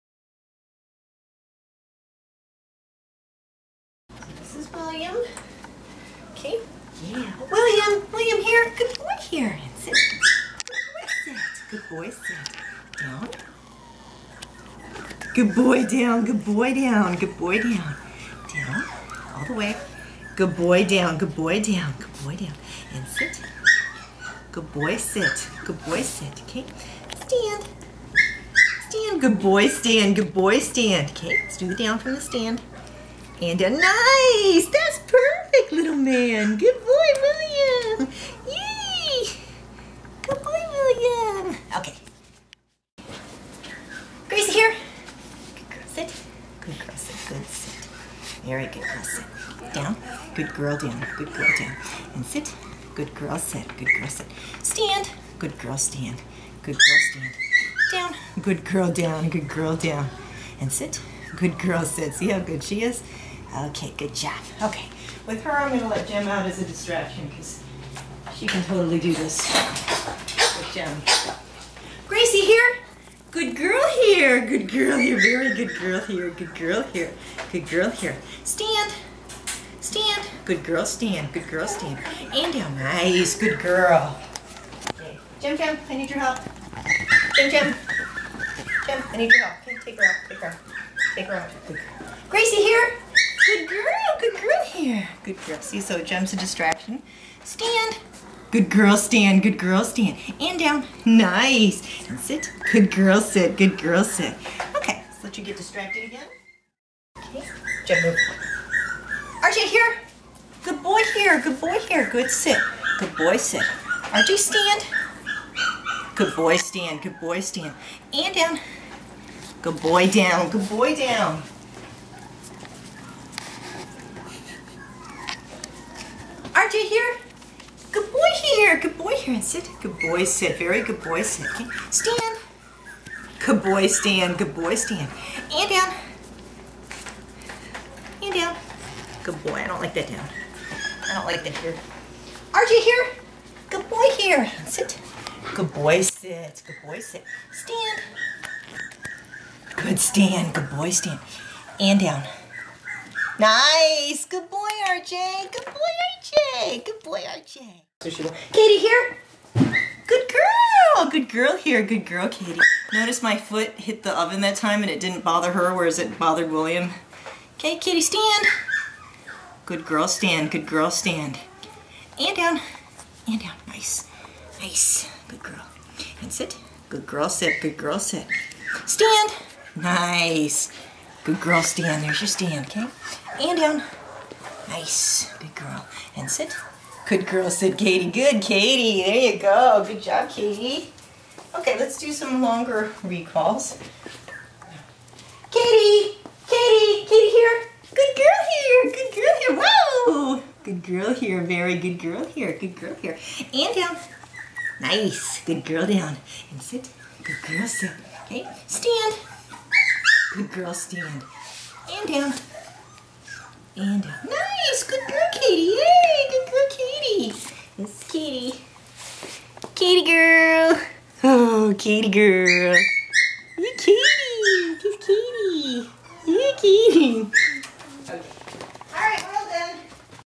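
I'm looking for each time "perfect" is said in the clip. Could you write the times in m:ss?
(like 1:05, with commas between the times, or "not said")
0:34.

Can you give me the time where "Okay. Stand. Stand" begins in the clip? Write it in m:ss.
0:26.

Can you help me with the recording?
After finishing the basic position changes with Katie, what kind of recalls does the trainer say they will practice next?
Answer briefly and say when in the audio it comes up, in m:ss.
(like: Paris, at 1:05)
longer recalls, at 3:12.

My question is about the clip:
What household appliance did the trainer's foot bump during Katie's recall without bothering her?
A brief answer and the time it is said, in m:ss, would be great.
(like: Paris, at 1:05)
oven, at 2:44.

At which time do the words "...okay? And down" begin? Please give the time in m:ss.
3:02.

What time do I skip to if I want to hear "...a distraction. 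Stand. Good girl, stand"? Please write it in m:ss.
1:36.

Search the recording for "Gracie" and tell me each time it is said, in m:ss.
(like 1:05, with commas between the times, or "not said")
0:44, 1:12, 1:32.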